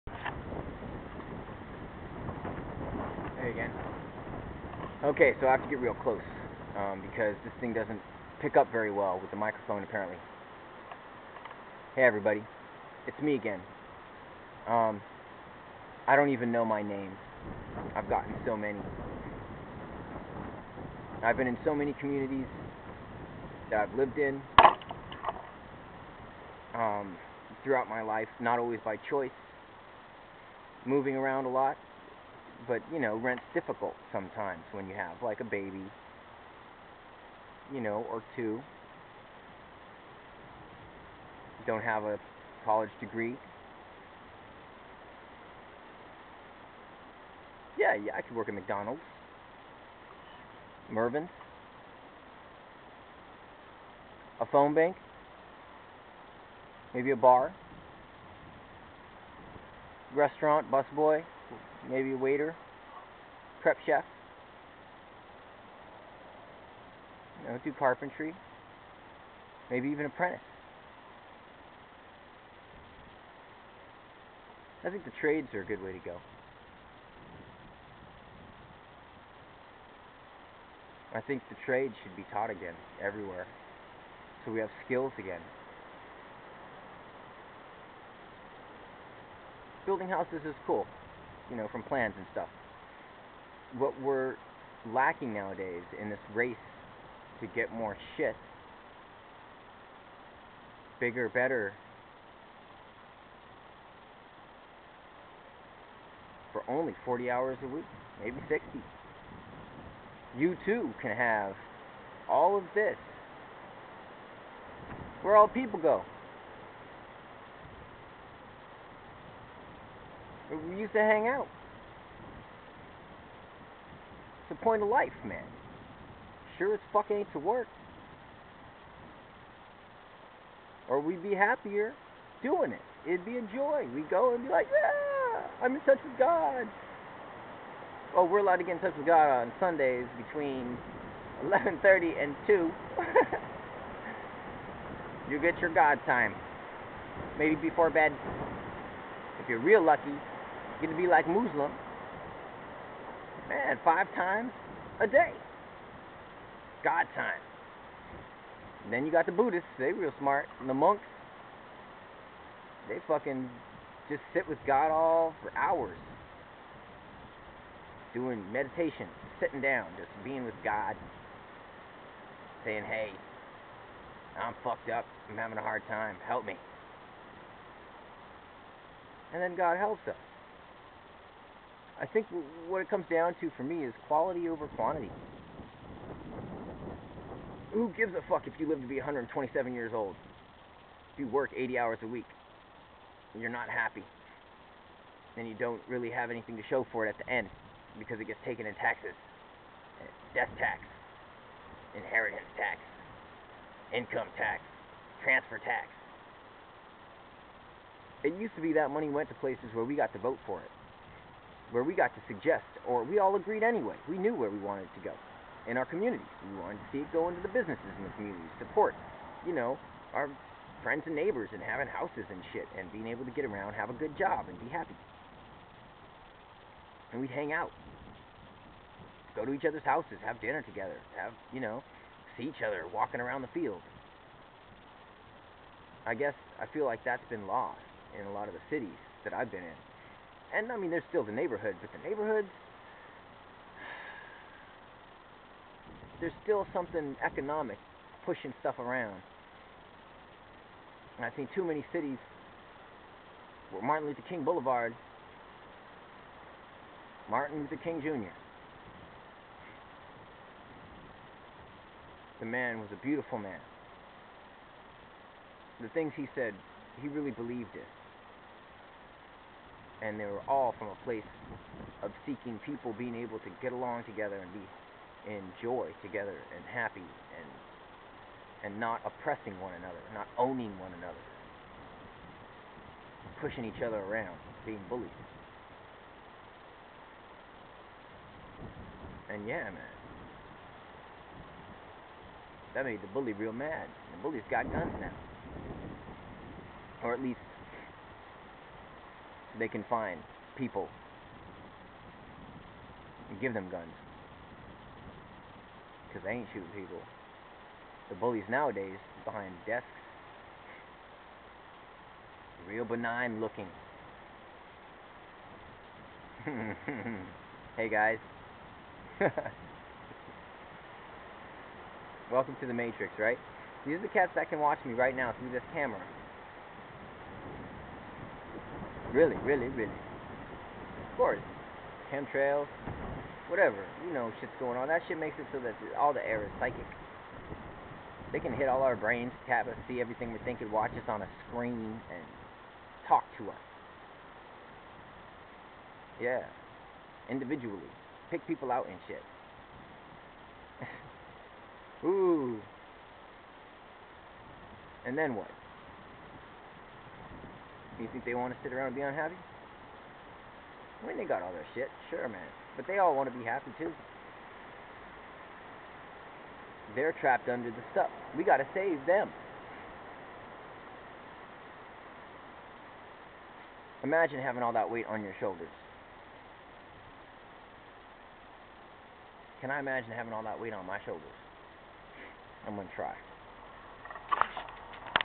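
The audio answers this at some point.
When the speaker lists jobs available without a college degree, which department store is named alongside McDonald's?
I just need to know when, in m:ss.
0:50.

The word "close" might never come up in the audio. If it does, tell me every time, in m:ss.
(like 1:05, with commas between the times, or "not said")
0:06.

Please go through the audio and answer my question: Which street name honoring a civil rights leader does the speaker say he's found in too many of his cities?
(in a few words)
Martin Luther King Boulevard.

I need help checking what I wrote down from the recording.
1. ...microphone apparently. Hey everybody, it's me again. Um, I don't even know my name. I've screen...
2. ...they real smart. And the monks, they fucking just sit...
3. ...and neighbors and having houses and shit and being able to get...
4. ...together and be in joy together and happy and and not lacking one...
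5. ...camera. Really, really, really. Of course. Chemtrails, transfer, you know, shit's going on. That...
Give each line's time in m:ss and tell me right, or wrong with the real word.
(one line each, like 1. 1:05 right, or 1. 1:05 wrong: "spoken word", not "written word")
1. 0:09 wrong: "gotten", not "screen"
2. 2:39 right
3. 3:41 right
4. 4:34 wrong: "oppressing", not "lacking"
5. 5:25 wrong: "whatever", not "transfer".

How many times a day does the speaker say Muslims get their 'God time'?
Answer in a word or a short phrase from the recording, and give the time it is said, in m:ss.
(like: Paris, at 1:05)
5, at 2:33.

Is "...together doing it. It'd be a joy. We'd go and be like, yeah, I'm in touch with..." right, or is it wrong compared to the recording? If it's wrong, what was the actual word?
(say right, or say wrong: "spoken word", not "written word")
wrong: "happier", not "together".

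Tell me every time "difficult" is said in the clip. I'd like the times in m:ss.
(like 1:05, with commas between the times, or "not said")
0:33.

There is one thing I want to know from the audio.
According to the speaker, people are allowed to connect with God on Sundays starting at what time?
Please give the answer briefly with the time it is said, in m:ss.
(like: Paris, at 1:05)
11:30, at 2:21.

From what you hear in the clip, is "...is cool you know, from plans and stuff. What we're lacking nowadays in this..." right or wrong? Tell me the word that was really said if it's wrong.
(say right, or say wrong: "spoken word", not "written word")
right.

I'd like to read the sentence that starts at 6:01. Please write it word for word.
I mean, they got all their shit, sure, man.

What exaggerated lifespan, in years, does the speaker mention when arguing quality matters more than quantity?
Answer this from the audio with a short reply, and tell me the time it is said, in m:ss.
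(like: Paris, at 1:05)
127, at 3:08.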